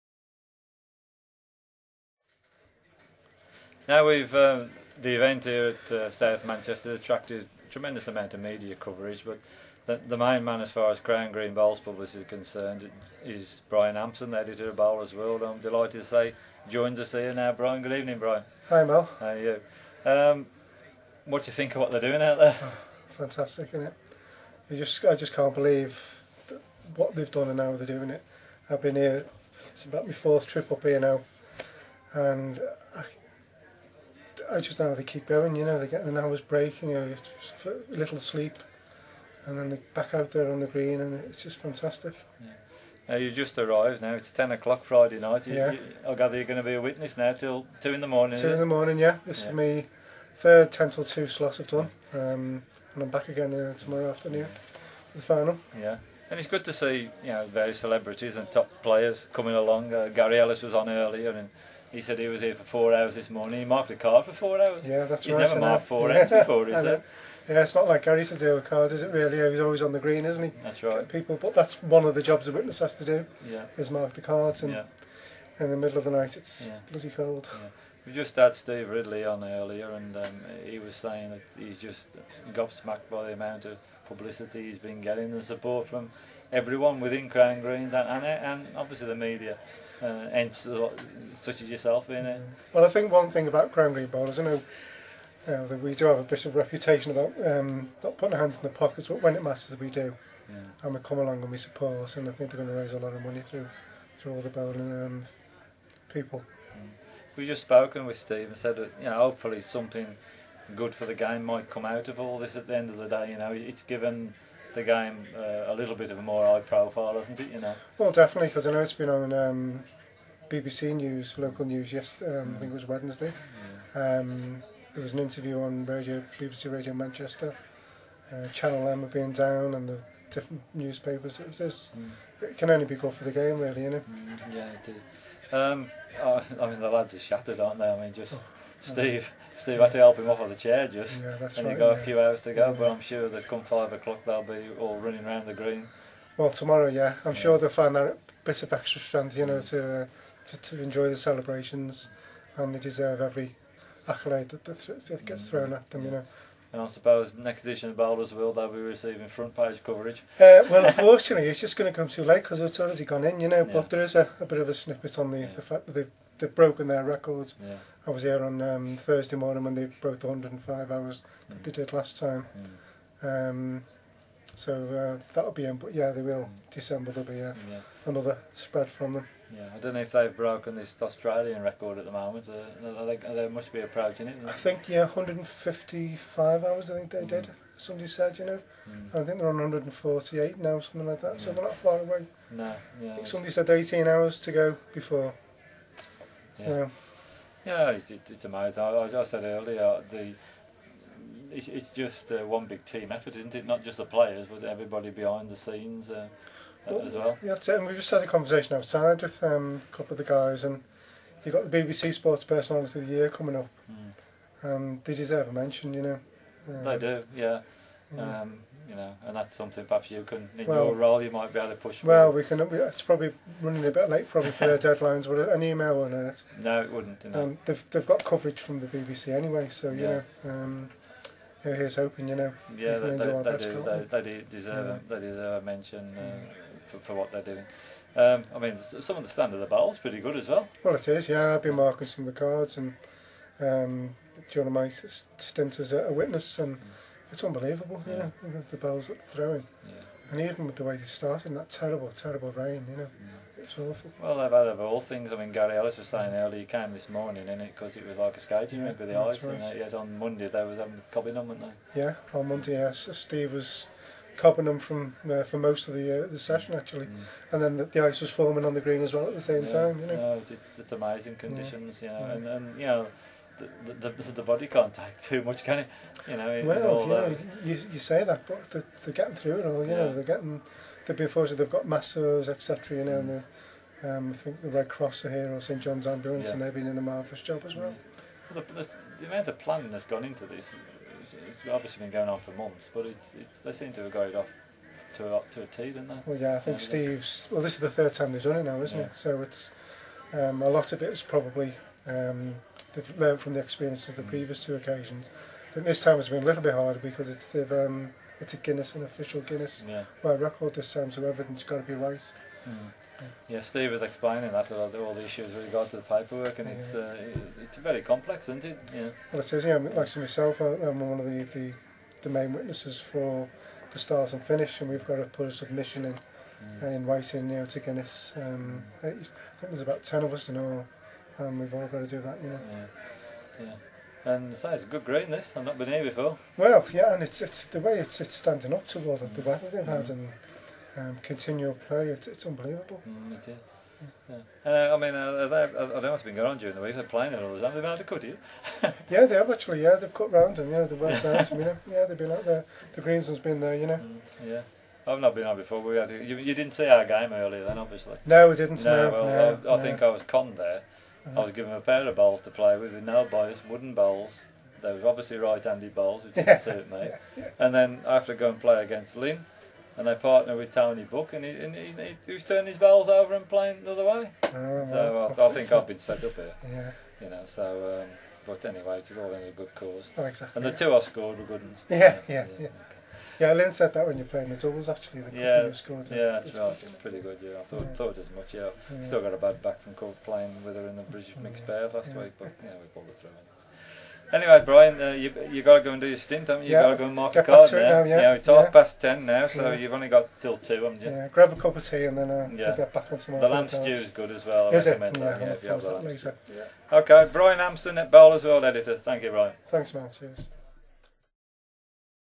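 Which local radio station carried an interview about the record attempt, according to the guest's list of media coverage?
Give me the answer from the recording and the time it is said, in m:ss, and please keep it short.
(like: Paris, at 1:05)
BBC Radio Manchester, at 2:06.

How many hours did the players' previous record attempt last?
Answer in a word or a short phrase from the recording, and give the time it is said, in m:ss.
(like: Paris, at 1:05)
105, at 2:50.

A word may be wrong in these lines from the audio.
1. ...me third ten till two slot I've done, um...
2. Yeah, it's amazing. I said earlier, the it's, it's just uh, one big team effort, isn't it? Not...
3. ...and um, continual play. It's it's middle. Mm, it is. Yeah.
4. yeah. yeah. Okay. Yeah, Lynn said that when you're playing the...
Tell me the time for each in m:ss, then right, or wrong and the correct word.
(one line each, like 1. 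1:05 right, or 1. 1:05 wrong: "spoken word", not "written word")
1. 0:49 right
2. 3:17 right
3. 5:40 wrong: "unbelievable", not "middle"
4. 6:22 right.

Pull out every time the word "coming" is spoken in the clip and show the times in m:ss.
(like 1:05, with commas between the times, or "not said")
0:59, 3:33.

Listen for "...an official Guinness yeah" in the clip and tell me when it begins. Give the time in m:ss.
5:08.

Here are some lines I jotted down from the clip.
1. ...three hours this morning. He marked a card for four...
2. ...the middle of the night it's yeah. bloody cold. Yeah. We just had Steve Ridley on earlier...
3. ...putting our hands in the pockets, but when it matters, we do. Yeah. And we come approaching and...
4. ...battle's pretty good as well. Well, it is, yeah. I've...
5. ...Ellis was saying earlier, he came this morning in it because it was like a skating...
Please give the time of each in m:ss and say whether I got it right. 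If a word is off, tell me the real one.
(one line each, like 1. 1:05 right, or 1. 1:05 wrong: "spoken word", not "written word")
1. 1:02 wrong: "four", not "three"
2. 1:15 right
3. 1:38 wrong: "along", not "approaching"
4. 3:59 right
5. 4:15 right.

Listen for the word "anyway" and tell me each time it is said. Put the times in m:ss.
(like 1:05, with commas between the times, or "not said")
3:49, 6:18, 6:34.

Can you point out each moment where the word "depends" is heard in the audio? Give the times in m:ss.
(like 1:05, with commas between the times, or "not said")
not said.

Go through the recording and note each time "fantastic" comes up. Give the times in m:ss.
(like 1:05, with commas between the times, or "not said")
0:23, 0:41.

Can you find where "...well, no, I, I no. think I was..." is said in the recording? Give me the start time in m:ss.
5:59.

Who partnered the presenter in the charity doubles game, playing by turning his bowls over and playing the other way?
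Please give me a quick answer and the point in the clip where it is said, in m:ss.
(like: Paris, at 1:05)
Tony Book, at 6:10.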